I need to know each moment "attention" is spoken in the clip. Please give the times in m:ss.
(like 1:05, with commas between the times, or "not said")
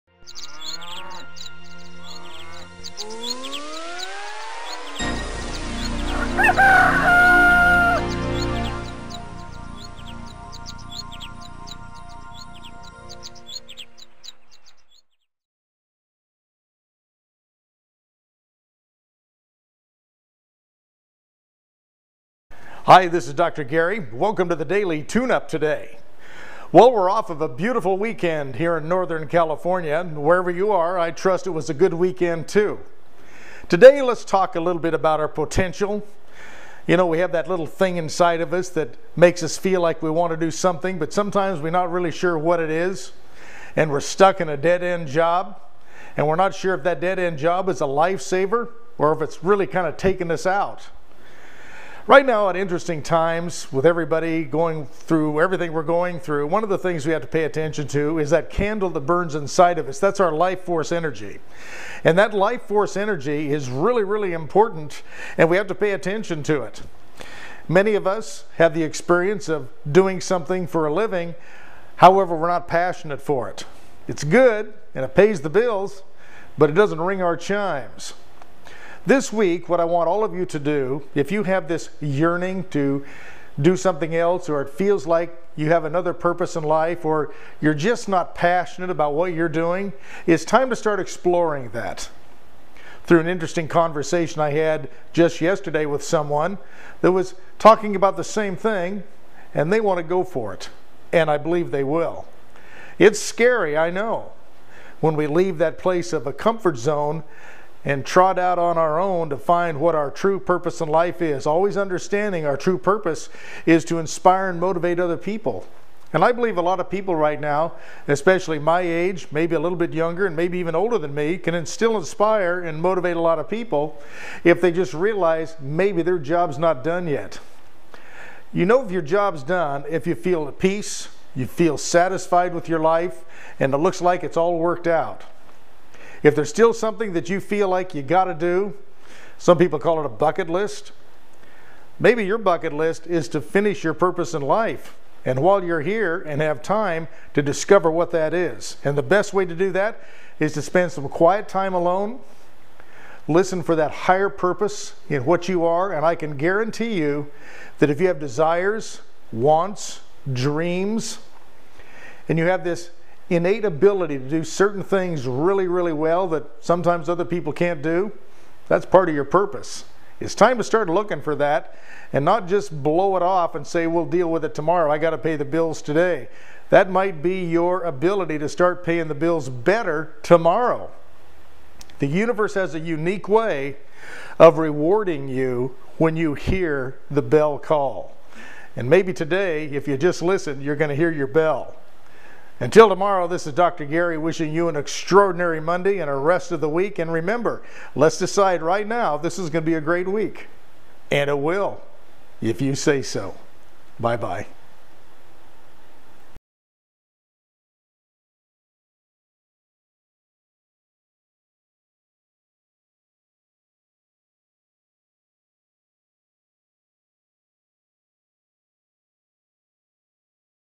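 0:57, 1:05.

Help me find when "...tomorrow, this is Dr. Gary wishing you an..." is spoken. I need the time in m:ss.
3:12.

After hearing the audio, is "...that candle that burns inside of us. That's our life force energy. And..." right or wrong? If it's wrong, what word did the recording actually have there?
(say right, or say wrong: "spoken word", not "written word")
right.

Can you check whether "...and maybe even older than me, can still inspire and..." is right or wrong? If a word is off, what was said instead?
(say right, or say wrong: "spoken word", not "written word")
right.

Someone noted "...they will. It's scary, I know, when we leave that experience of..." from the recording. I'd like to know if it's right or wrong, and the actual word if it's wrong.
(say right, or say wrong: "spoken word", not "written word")
wrong: "place", not "experience".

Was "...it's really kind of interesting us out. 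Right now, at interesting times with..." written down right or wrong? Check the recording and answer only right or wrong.
wrong.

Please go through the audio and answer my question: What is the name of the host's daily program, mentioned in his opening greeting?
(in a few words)
Daily Tune Up.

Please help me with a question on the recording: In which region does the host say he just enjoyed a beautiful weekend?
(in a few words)
Northern California.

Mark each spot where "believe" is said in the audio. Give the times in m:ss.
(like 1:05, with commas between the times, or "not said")
1:41, 1:56.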